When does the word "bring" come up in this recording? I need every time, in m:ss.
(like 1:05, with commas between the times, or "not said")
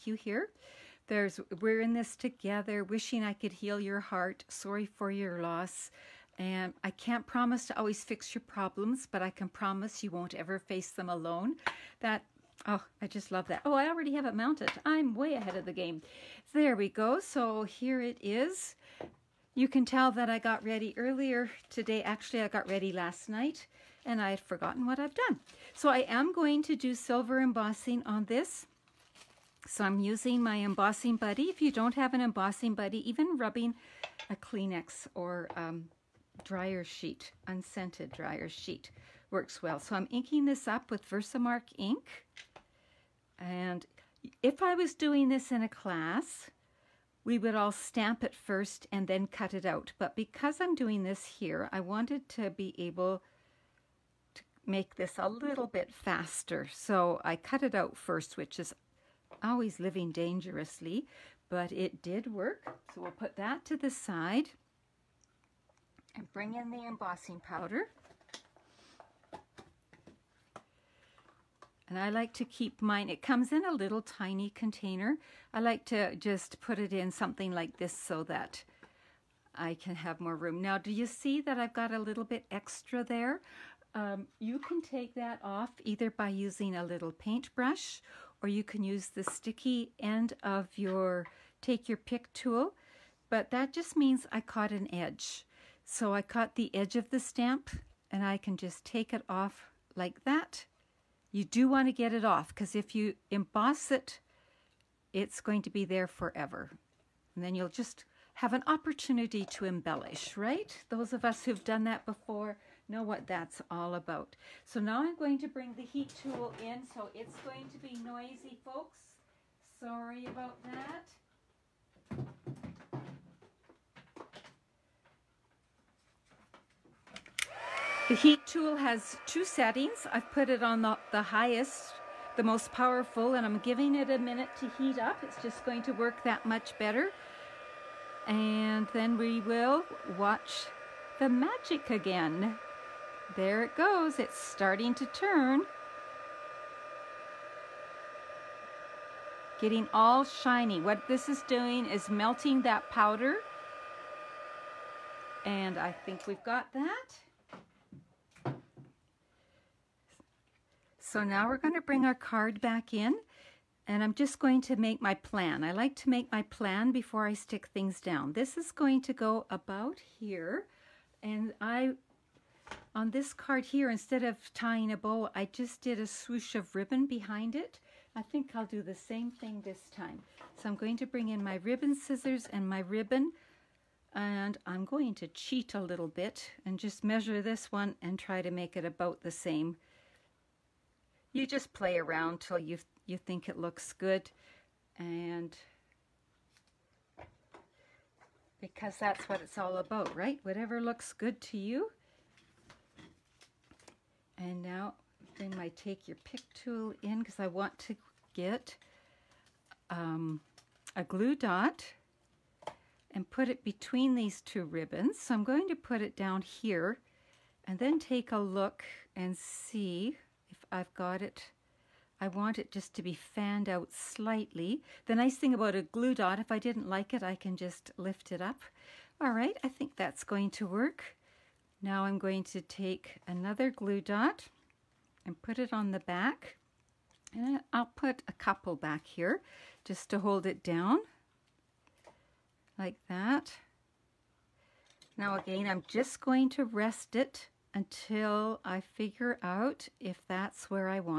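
1:06, 1:55, 2:41, 3:01, 3:25.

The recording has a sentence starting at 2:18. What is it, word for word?
And then we will watch the magic again.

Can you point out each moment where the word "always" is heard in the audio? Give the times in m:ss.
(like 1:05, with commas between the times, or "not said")
0:07, 0:59.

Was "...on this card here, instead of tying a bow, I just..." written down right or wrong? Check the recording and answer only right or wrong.
right.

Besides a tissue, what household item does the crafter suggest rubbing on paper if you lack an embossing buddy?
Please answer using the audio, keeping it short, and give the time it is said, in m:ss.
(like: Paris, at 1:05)
unscented dryer sheet, at 0:37.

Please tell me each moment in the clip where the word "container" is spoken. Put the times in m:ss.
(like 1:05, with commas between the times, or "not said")
1:14.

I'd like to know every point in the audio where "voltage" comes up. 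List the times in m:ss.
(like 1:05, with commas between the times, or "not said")
not said.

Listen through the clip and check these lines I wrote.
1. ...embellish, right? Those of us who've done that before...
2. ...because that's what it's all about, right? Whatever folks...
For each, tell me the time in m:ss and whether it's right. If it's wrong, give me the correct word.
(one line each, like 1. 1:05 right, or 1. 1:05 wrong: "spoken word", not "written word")
1. 1:49 right
2. 3:18 wrong: "looks", not "folks".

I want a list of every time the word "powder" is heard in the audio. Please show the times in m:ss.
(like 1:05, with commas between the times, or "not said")
1:07, 2:32.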